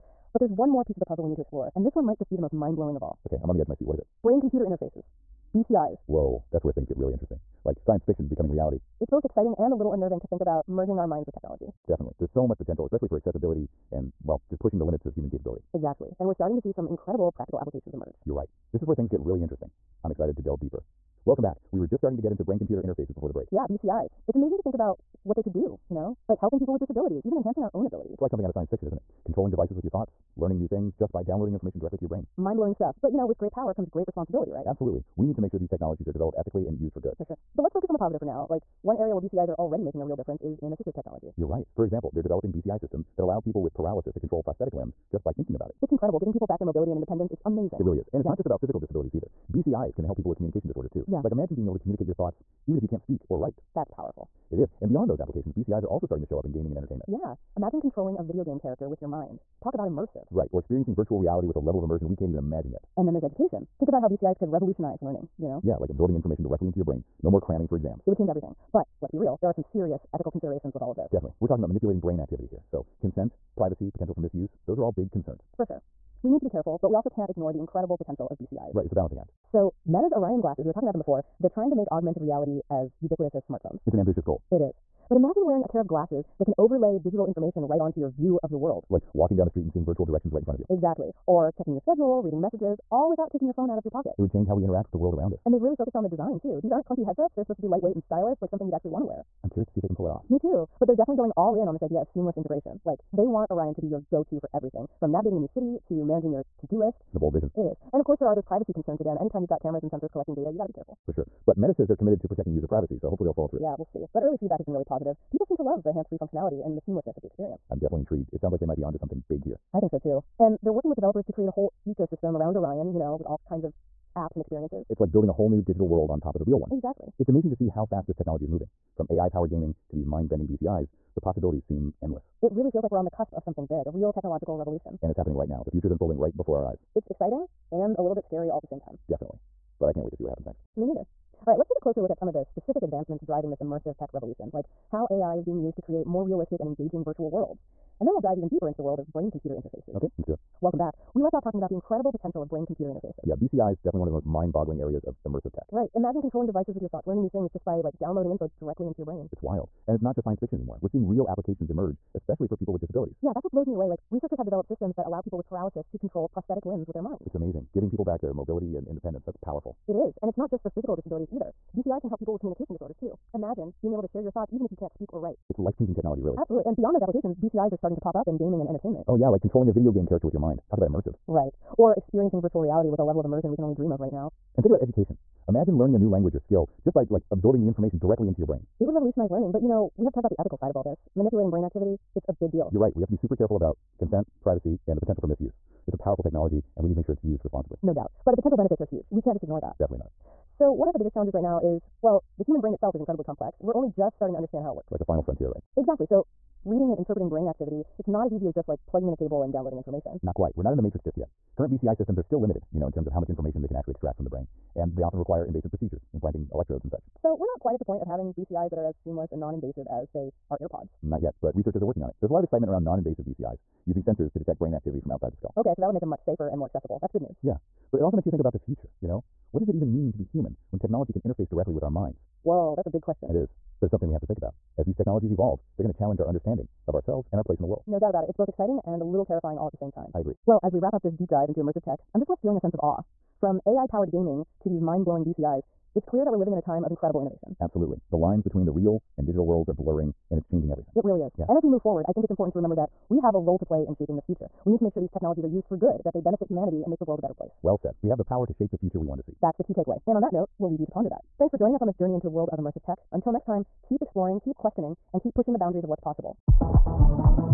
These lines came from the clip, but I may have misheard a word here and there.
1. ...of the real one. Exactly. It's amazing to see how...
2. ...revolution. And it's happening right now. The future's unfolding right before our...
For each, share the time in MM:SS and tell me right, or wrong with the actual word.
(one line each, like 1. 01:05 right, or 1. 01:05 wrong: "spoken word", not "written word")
1. 02:06 right
2. 02:14 right.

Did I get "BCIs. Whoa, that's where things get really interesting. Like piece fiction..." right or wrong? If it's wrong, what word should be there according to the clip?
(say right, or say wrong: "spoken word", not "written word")
wrong: "science", not "piece".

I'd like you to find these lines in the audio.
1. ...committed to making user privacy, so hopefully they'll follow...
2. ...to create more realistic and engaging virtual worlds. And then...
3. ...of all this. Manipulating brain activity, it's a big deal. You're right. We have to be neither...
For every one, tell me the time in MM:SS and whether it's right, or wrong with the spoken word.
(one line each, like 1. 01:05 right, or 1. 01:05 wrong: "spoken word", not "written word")
1. 01:51 wrong: "protecting", not "making"
2. 02:25 right
3. 03:10 wrong: "super", not "neither".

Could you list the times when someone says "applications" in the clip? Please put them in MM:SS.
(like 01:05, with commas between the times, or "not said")
00:17, 00:55, 02:41, 02:56.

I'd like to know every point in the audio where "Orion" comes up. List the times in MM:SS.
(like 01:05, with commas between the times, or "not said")
01:20, 01:43, 02:02.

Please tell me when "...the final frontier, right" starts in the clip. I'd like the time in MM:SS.
03:24.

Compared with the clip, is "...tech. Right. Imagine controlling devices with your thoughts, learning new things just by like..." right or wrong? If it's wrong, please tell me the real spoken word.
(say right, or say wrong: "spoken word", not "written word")
right.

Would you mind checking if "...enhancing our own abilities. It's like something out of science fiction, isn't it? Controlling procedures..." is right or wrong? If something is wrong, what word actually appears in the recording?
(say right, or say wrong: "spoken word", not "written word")
wrong: "devices", not "procedures".